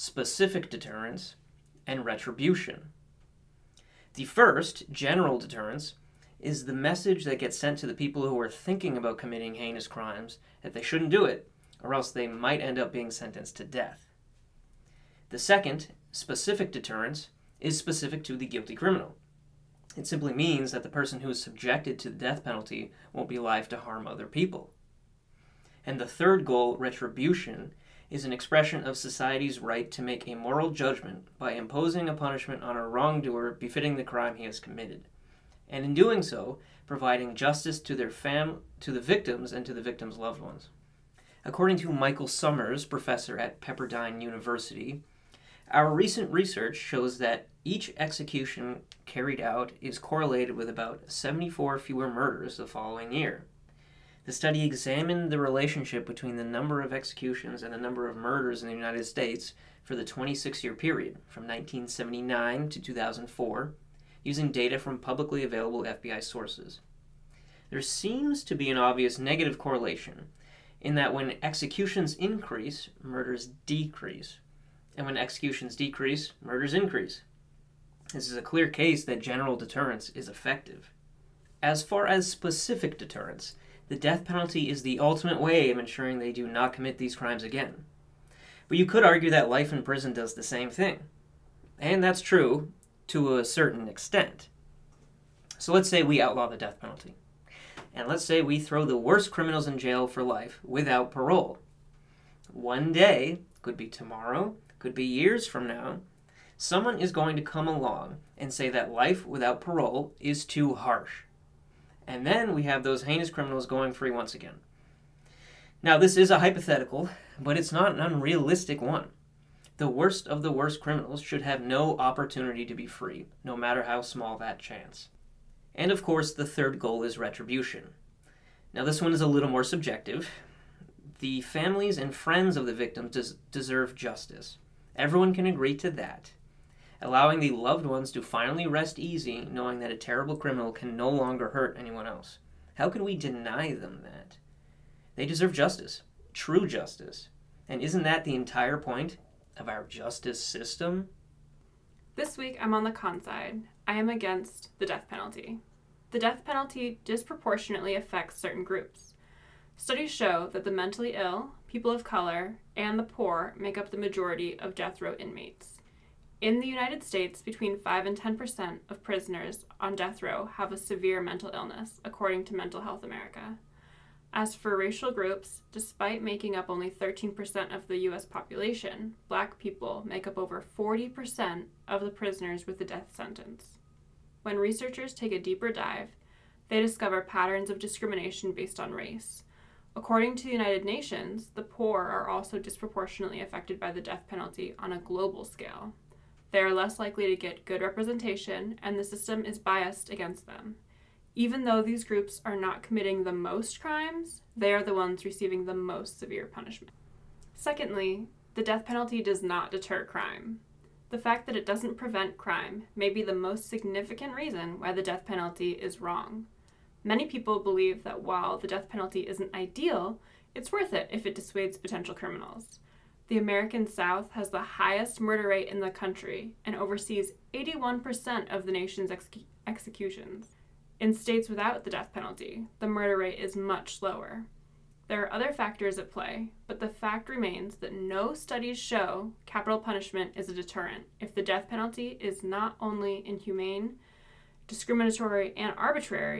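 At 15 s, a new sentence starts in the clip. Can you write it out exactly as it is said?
The second, specific deterrence, is specific to the guilty criminal.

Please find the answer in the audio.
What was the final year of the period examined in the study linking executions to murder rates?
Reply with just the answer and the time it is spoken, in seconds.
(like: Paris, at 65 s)
2004, at 62 s.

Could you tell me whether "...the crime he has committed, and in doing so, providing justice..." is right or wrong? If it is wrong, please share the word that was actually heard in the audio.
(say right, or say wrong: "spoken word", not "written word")
right.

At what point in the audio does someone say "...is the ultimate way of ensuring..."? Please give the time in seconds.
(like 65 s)
84 s.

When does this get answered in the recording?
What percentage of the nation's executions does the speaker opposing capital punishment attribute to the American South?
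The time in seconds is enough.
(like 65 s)
227 s.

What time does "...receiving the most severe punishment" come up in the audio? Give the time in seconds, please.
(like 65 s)
205 s.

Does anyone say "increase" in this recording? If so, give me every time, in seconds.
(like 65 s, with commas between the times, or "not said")
72 s, 76 s.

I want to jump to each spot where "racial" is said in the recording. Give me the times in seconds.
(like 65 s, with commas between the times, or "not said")
174 s.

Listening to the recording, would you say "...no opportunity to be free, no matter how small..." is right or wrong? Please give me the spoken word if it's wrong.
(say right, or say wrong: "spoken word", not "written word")
right.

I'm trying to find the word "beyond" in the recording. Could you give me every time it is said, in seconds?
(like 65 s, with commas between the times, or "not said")
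not said.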